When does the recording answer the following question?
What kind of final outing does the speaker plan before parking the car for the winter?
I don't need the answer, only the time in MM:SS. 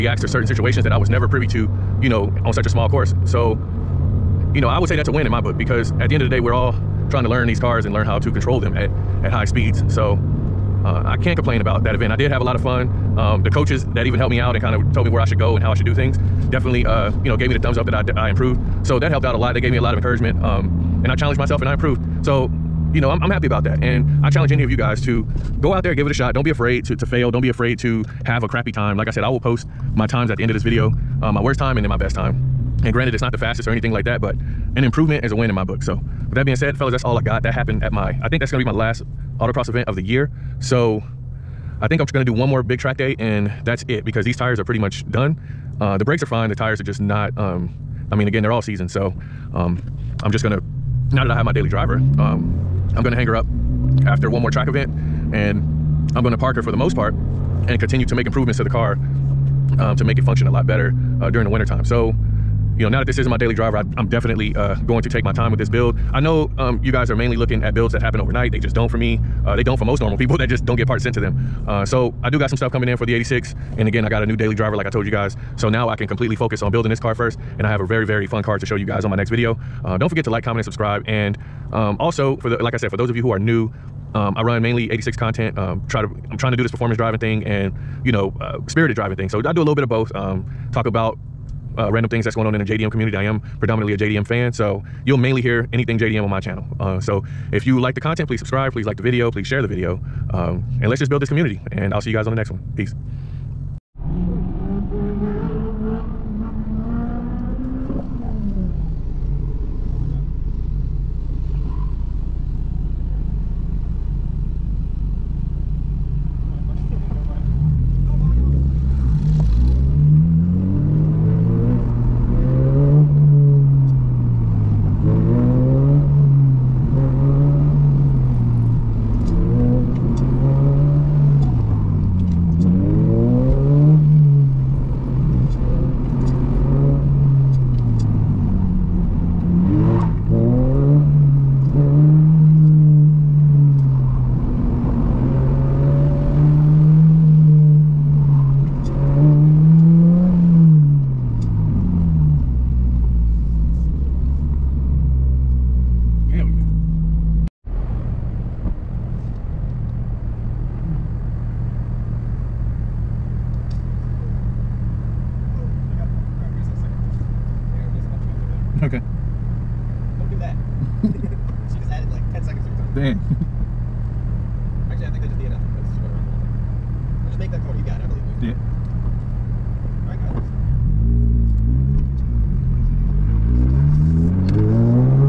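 00:54.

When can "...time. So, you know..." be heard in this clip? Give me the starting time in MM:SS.
01:01.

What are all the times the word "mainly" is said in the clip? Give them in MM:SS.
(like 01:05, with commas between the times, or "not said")
01:07, 01:24, 01:35.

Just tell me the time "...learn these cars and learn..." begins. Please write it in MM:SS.
00:07.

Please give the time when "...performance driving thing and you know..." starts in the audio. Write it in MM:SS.
01:26.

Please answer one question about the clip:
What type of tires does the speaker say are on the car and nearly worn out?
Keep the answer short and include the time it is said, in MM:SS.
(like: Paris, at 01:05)
All seasons, at 00:48.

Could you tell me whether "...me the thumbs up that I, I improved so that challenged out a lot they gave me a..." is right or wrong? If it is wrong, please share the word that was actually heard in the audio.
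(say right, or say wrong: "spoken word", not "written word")
wrong: "helped", not "challenged".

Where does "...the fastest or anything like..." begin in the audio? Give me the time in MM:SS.
00:33.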